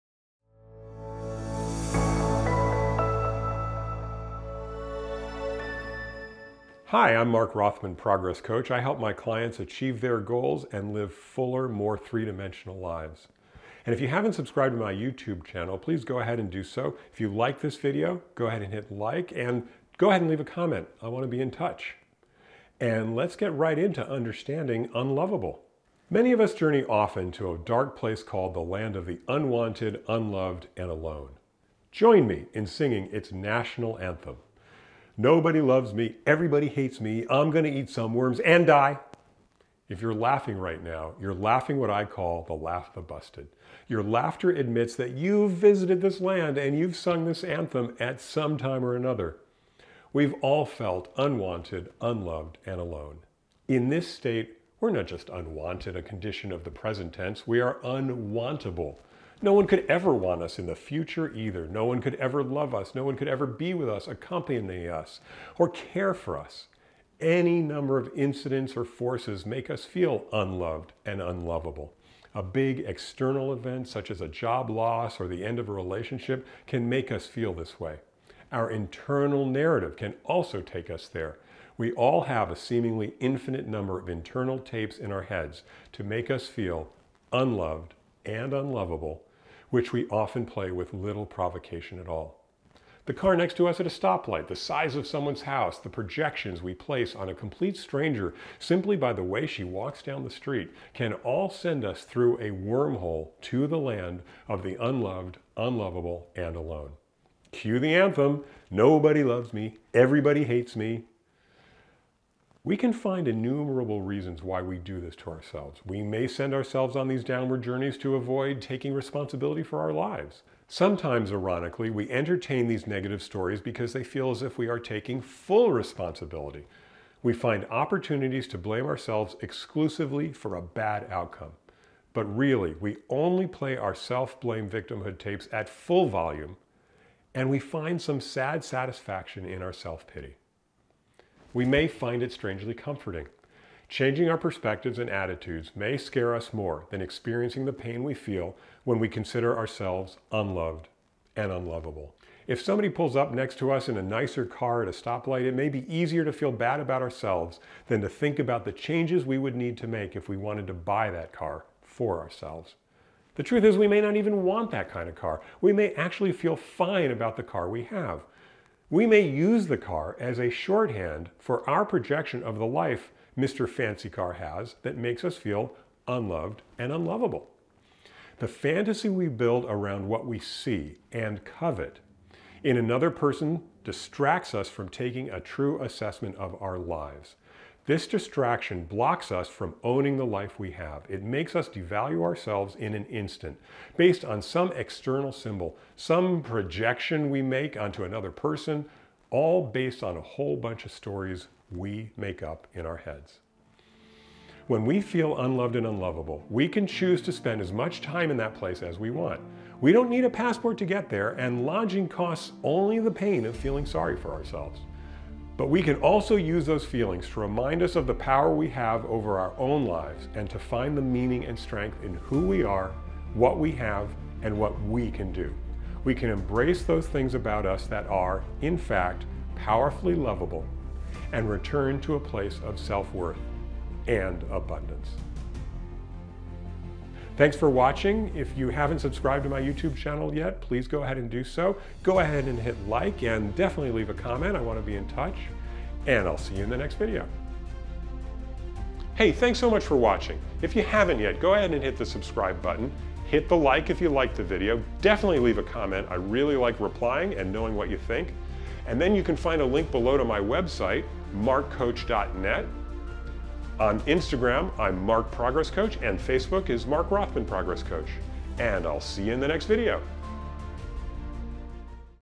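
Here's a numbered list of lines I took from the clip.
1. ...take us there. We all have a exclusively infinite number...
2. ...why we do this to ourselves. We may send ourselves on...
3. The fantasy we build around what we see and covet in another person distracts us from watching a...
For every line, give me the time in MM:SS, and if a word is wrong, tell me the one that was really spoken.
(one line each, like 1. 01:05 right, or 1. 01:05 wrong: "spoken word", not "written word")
1. 01:20 wrong: "seemingly", not "exclusively"
2. 01:54 right
3. 02:58 wrong: "taking", not "watching".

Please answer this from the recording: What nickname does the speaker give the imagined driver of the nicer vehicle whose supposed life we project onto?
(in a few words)
Mr. Fancy Car.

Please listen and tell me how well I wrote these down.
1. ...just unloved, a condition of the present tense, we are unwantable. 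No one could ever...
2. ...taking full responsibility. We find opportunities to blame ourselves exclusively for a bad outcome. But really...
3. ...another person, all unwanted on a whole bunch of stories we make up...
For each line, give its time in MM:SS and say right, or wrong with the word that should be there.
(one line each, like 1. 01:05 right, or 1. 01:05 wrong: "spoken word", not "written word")
1. 00:55 wrong: "unwanted", not "unloved"
2. 02:04 right
3. 03:18 wrong: "based", not "unwanted".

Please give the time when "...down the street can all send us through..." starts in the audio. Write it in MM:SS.
01:40.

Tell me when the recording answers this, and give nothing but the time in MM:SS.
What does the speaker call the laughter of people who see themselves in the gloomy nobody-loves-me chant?
00:42.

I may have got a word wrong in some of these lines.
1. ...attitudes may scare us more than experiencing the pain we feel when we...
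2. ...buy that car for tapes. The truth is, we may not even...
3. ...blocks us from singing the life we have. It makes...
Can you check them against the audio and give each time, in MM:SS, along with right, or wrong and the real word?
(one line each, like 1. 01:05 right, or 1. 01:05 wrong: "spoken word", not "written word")
1. 02:25 right
2. 02:40 wrong: "ourselves", not "tapes"
3. 03:08 wrong: "owning", not "singing".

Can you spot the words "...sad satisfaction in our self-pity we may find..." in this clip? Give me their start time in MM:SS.
02:18.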